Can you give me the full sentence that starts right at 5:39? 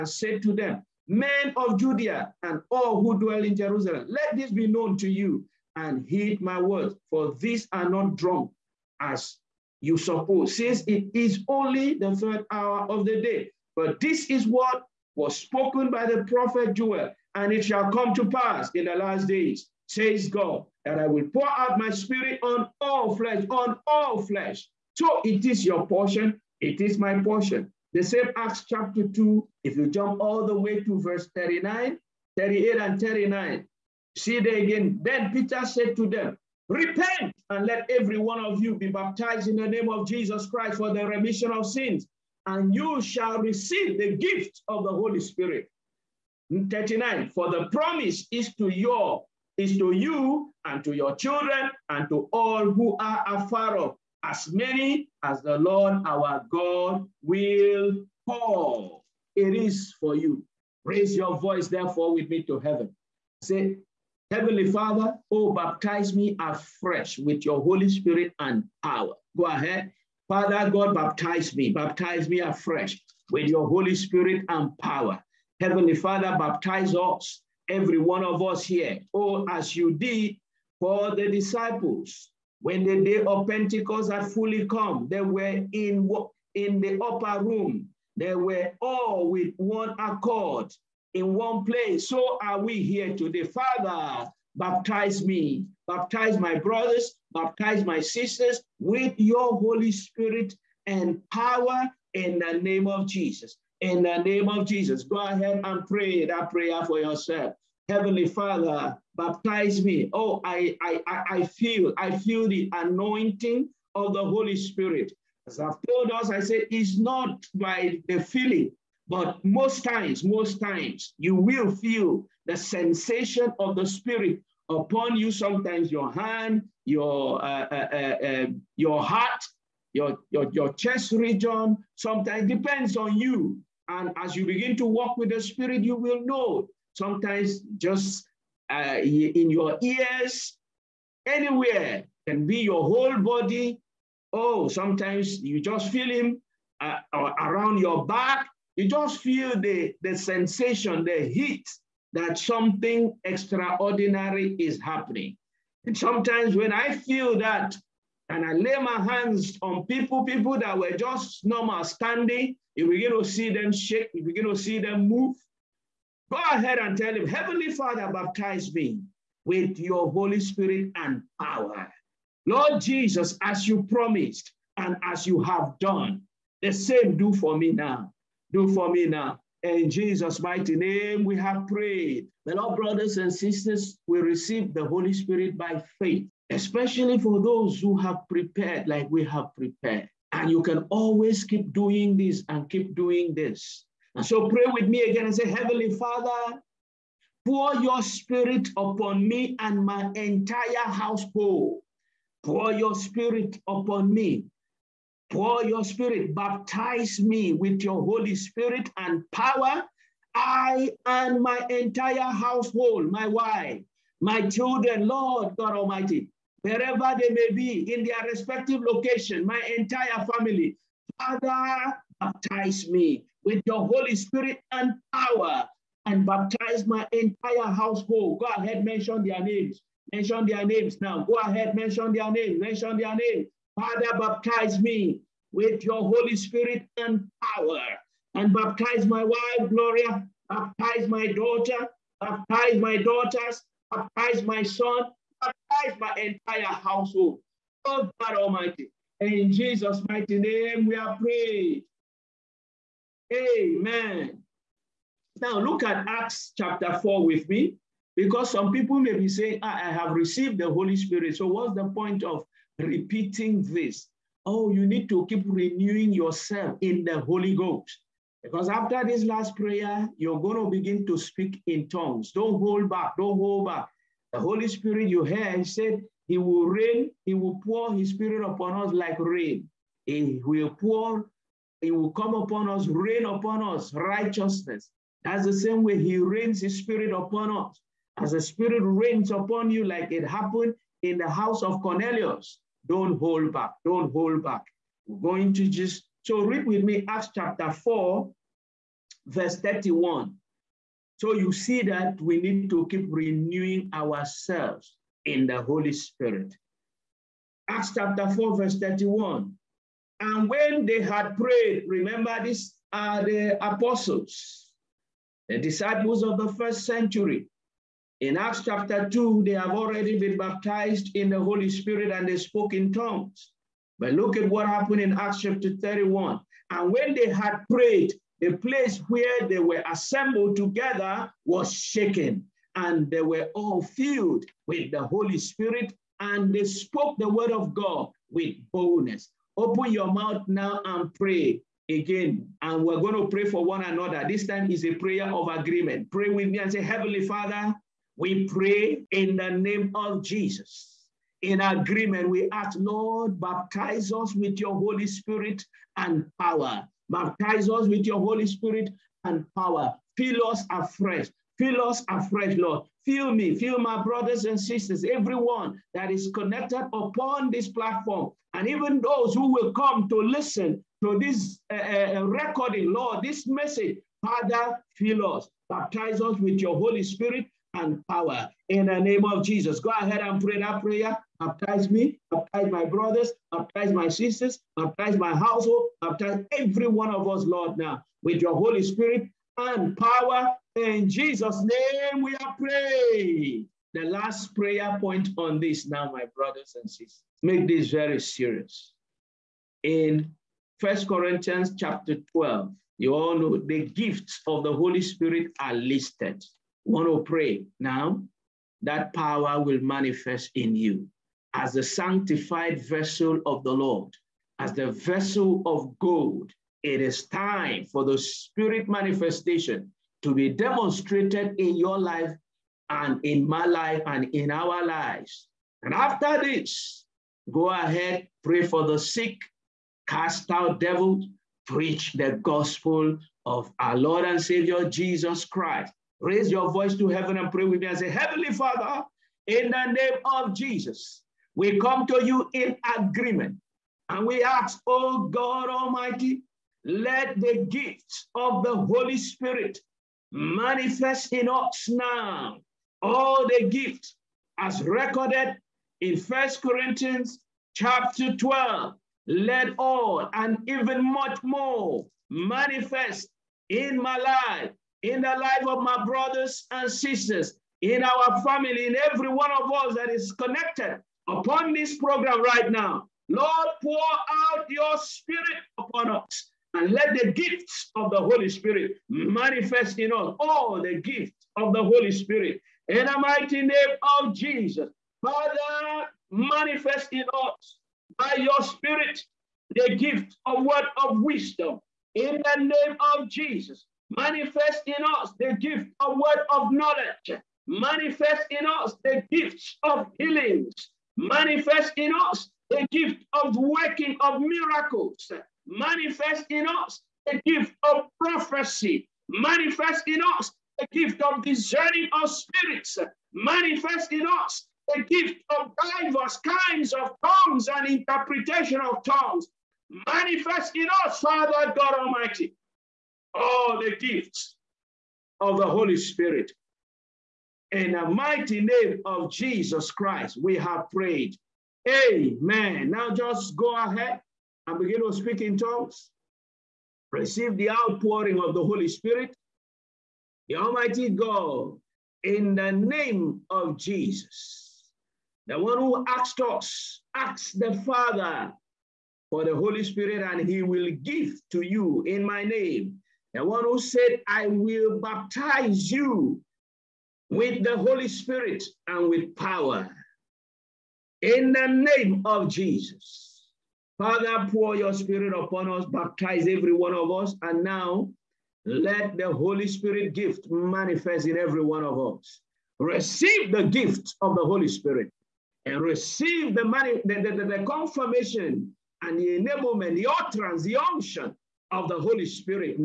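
Open your mouth now and pray again.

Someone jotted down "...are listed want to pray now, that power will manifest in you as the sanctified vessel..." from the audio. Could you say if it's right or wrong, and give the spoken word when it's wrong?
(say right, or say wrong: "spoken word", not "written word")
right.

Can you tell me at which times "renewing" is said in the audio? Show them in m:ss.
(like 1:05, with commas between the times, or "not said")
4:25, 5:03.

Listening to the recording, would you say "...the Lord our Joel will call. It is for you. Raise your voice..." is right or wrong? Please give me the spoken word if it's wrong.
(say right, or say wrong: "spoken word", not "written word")
wrong: "God", not "Joel".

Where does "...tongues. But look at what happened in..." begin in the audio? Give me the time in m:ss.
5:22.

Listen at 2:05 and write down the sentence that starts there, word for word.
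Sometimes your hand, your, uh, uh, uh, uh, your heart, your, your, your chest region, sometimes depends on you.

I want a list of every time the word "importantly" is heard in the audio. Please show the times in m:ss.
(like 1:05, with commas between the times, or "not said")
not said.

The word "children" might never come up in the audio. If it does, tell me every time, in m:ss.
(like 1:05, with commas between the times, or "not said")
0:51, 3:34.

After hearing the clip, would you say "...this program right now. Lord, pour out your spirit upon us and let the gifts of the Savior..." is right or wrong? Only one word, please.
wrong.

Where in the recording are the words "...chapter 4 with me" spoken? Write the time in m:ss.
4:16.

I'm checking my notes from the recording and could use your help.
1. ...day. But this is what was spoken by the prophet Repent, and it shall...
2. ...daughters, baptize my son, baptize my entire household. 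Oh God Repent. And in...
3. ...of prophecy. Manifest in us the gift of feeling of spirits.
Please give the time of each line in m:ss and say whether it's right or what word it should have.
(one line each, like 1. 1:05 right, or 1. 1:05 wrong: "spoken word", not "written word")
1. 0:13 wrong: "Joel", not "Repent"
2. 4:02 wrong: "Almighty", not "Repent"
3. 8:27 wrong: "discerning", not "feeling".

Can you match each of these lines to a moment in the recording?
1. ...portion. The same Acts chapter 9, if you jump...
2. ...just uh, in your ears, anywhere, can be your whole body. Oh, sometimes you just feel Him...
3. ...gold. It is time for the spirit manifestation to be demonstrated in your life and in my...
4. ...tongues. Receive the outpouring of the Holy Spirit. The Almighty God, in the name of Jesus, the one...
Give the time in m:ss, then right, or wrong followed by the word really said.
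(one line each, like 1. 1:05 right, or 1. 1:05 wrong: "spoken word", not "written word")
1. 0:27 wrong: "2", not "9"
2. 2:17 right
3. 6:55 right
4. 8:55 right.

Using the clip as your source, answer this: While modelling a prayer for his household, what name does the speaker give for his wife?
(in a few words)
Gloria.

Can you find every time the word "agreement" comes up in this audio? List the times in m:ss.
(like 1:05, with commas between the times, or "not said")
5:45, 5:51, 7:22.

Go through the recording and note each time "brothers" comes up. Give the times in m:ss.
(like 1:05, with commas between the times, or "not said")
1:36, 3:02, 6:04, 6:22, 6:36, 7:46.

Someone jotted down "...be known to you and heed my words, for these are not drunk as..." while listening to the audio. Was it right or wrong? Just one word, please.
right.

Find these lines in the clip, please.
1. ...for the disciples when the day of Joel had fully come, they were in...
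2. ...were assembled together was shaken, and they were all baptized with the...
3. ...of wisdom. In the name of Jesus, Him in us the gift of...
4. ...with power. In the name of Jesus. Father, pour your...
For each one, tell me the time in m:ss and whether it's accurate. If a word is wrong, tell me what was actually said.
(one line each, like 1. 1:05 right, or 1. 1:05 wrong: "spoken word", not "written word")
1. 1:20 wrong: "Pentecost", not "Joel"
2. 5:29 wrong: "filled", not "baptized"
3. 8:11 wrong: "Manifest", not "Him"
4. 9:19 right.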